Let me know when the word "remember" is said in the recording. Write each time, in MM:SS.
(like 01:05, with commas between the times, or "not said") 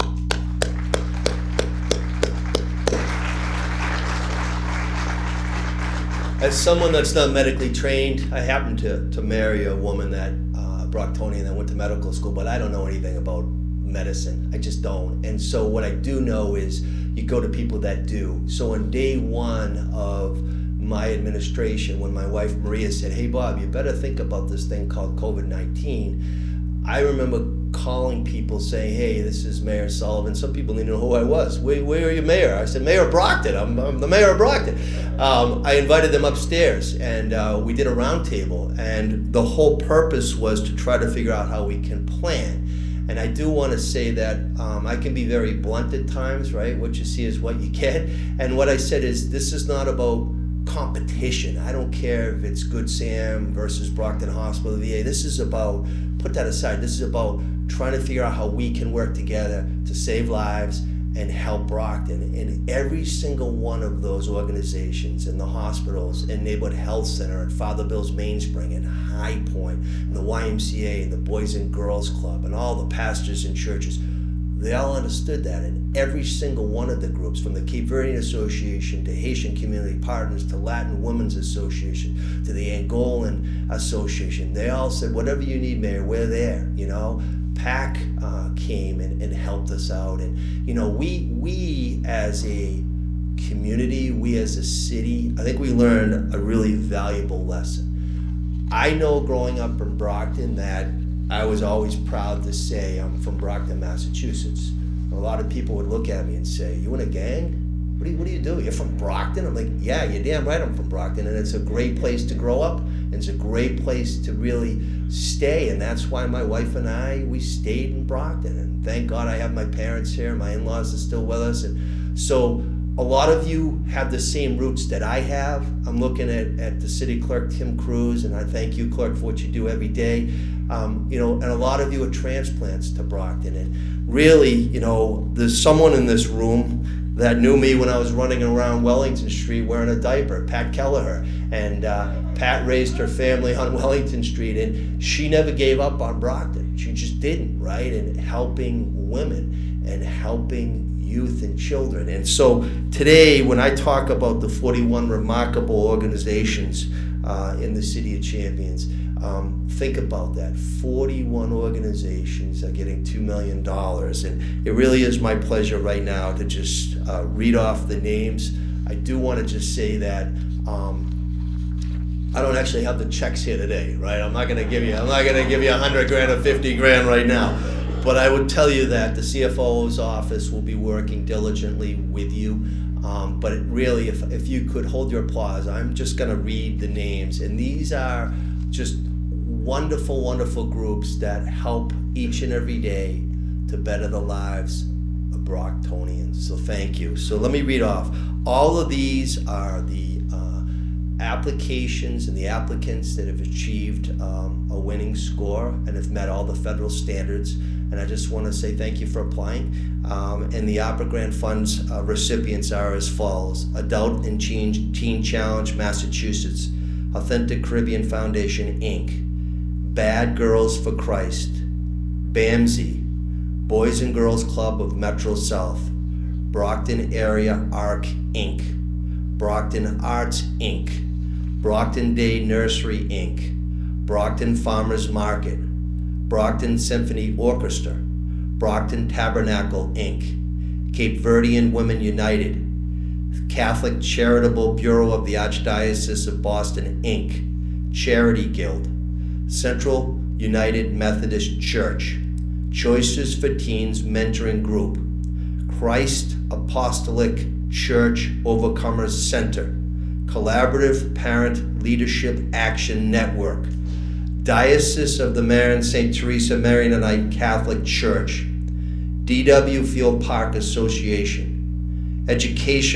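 00:26.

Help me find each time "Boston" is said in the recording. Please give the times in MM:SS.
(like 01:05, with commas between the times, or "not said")
04:06.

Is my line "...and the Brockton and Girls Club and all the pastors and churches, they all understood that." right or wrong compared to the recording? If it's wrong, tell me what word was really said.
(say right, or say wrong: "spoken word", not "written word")
wrong: "Boys", not "Brockton".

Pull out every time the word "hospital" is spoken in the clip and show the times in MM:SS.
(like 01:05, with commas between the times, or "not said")
00:54, 01:05.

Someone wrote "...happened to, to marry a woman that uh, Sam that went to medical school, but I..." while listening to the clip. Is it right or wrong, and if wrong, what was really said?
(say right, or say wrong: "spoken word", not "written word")
wrong: "Brocktonian", not "Sam".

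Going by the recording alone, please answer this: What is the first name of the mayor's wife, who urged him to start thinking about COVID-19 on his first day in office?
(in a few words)
Maria.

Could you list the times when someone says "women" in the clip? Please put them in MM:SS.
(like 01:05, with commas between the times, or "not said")
01:21, 02:29, 04:01.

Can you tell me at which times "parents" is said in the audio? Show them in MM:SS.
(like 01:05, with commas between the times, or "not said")
01:59, 04:21.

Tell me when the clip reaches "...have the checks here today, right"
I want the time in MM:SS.
02:52.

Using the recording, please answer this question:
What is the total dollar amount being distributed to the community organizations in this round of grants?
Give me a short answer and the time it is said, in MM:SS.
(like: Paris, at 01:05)
$2 million, at 02:42.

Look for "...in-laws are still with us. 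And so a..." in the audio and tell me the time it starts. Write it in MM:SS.
02:00.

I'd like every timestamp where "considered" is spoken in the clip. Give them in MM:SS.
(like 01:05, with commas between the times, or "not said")
not said.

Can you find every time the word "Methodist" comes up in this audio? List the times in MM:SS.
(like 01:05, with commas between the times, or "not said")
04:10.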